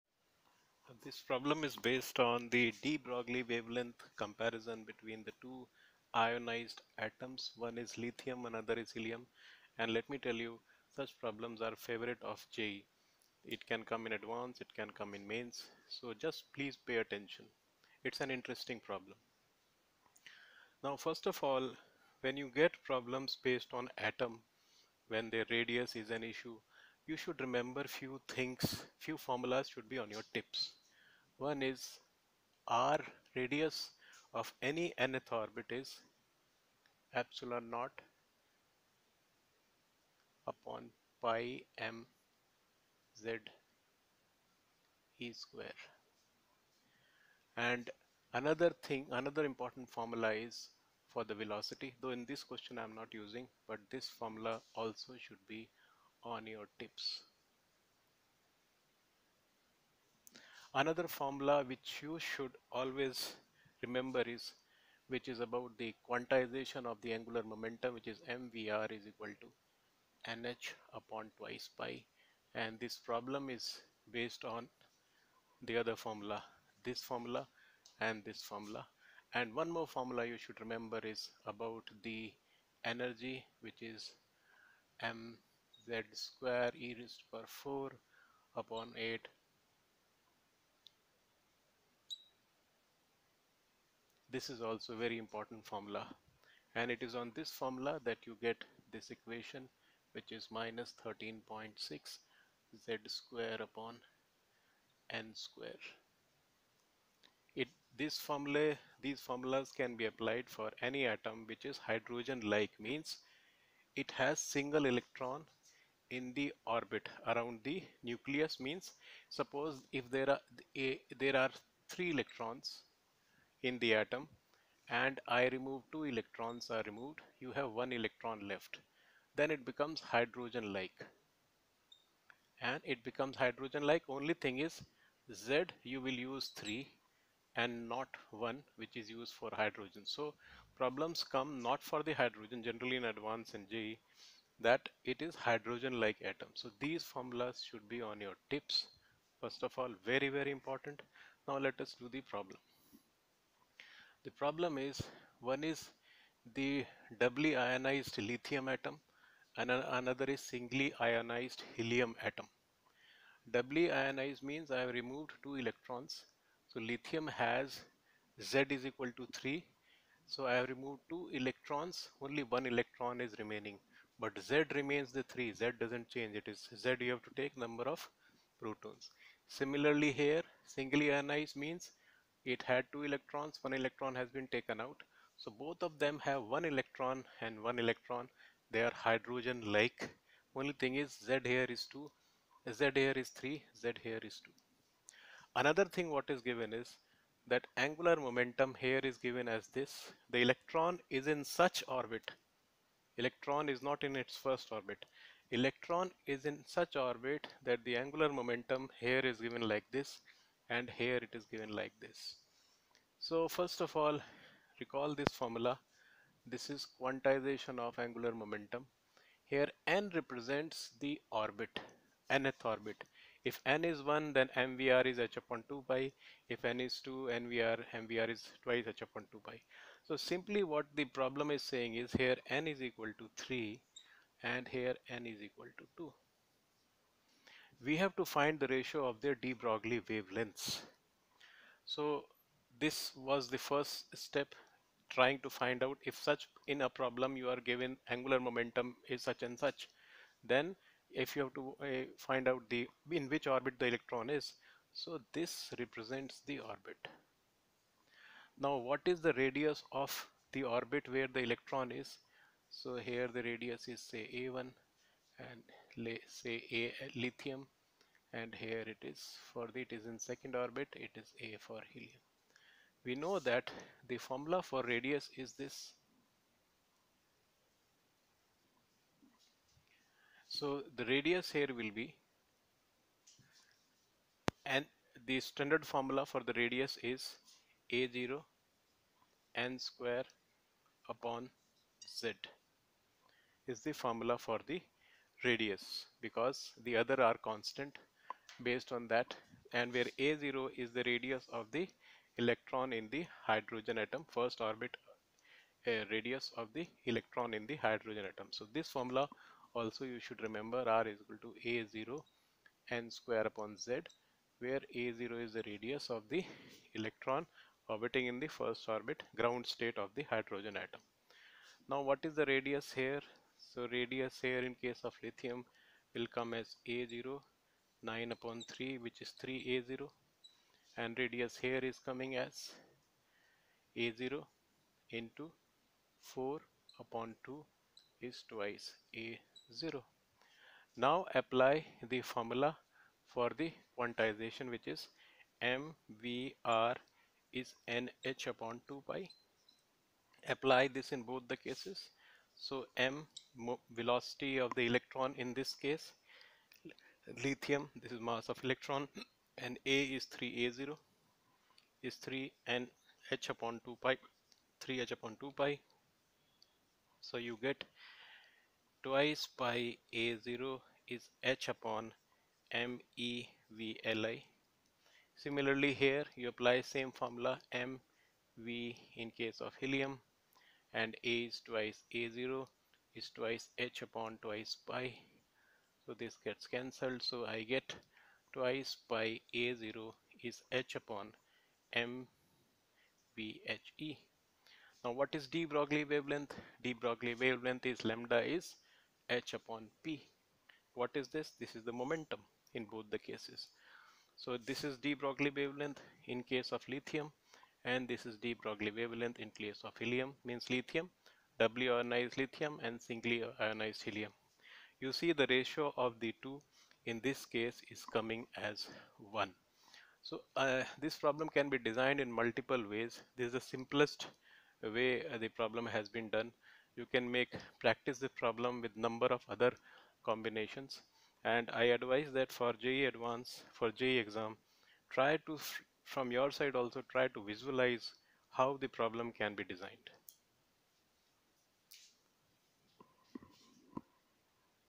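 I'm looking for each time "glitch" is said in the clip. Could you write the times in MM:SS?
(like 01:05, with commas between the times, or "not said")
not said.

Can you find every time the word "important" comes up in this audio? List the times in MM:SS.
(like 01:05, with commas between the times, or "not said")
00:49, 01:35, 02:30.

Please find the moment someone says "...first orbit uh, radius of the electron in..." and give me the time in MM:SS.
05:04.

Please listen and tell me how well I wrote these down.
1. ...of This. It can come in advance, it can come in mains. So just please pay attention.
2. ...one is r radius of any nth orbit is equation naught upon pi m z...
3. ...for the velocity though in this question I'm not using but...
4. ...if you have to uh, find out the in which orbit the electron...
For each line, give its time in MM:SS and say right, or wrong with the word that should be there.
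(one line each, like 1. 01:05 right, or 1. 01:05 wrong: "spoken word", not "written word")
1. 00:12 wrong: "JEE", not "This"
2. 00:31 wrong: "epsilon", not "equation"
3. 00:51 right
4. 04:11 right.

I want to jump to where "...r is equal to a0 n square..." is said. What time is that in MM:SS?
05:10.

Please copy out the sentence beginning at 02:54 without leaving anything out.
But Z remains the 3, Z doesn't change.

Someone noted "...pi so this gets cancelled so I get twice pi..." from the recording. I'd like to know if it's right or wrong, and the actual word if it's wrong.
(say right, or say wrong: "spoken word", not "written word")
right.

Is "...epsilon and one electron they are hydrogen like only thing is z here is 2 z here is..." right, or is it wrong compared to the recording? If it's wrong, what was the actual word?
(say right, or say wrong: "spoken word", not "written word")
wrong: "electron", not "epsilon".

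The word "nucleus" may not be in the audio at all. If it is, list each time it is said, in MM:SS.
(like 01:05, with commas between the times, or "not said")
01:58.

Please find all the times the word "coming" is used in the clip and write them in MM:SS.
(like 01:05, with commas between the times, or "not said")
05:32, 06:58.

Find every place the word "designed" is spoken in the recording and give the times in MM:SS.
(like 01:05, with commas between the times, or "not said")
07:01, 07:19.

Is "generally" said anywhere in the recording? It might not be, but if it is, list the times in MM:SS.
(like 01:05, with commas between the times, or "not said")
02:22.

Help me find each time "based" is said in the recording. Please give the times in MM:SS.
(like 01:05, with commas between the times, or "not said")
00:01, 00:23, 01:14, 04:58.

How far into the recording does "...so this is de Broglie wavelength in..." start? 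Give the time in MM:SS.
06:44.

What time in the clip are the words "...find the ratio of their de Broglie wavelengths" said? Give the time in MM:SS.
03:58.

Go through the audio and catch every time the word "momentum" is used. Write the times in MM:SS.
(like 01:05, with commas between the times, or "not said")
01:07, 03:18, 03:28, 03:38, 04:08, 06:42.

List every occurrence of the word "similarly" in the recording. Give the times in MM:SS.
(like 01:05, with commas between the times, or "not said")
02:59, 06:15.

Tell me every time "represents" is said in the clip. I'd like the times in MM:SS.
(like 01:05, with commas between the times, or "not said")
03:40, 04:15.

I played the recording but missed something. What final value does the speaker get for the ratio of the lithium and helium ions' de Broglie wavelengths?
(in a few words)
1.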